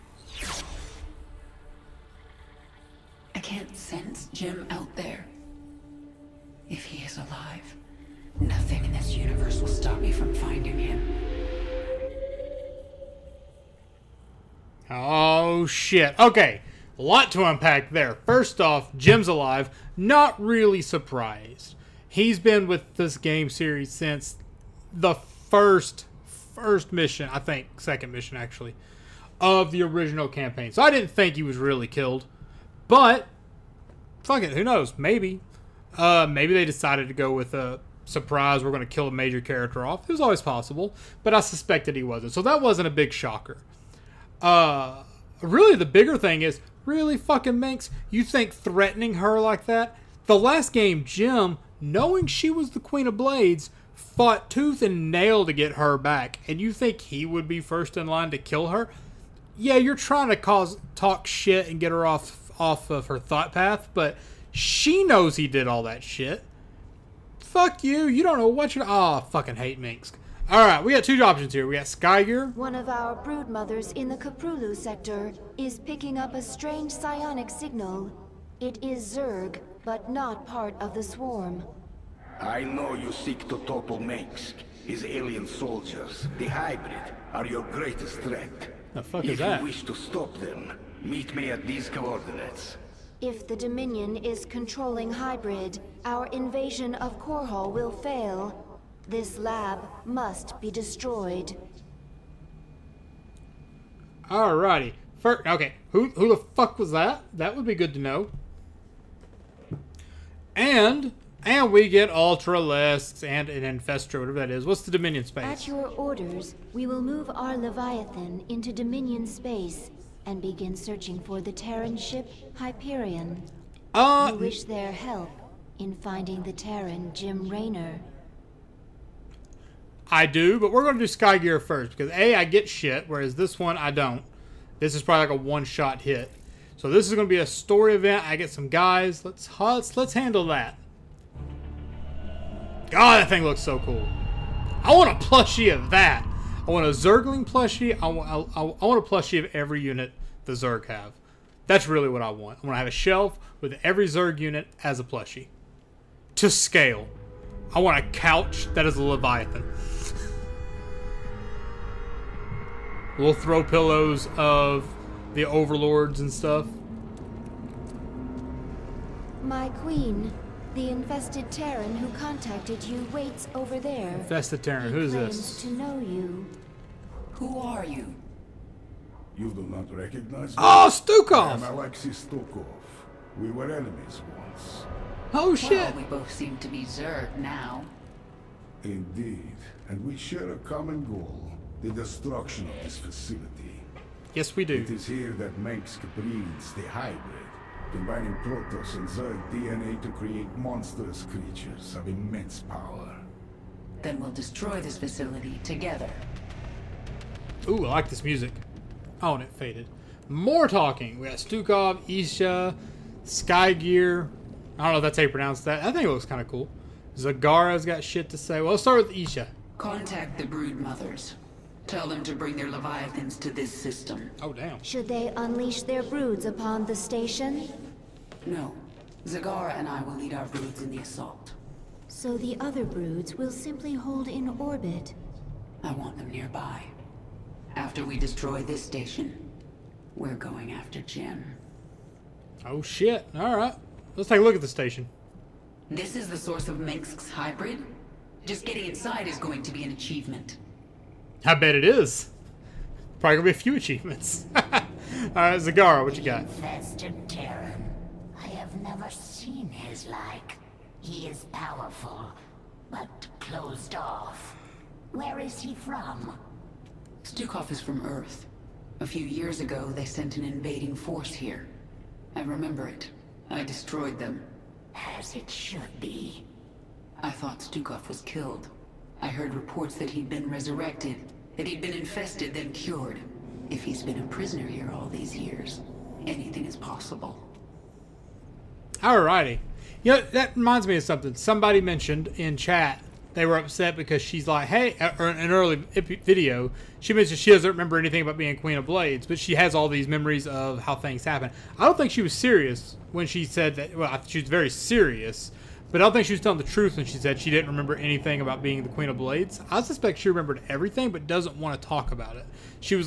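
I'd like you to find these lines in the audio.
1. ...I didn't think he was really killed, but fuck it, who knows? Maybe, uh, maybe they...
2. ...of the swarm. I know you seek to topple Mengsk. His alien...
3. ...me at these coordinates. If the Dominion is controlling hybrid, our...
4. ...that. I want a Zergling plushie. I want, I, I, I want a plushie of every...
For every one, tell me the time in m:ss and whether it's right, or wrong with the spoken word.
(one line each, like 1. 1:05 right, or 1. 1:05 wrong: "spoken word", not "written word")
1. 0:30 right
2. 1:20 right
3. 1:31 right
4. 2:25 right.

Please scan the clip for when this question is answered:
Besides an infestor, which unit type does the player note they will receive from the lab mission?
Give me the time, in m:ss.
1:52.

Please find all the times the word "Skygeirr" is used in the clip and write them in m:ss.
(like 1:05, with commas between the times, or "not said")
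1:11, 2:11, 3:33.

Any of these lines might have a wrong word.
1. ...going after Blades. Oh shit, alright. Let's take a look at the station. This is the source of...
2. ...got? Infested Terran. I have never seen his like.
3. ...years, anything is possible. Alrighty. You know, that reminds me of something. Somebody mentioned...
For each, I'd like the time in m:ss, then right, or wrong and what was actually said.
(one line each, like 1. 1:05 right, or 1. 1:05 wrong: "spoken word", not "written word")
1. 4:00 wrong: "Jim", not "Blades"
2. 4:16 right
3. 4:45 right.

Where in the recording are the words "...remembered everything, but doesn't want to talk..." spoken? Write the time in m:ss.
5:10.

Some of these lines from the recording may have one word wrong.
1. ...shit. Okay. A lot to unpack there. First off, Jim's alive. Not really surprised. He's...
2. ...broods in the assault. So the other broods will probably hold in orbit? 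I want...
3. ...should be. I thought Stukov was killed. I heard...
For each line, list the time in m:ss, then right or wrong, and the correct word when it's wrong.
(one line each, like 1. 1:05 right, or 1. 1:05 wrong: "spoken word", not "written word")
1. 0:15 right
2. 3:50 wrong: "simply", not "probably"
3. 4:35 right.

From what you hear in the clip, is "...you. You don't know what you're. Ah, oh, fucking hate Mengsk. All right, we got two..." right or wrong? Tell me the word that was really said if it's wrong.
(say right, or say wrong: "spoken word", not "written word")
right.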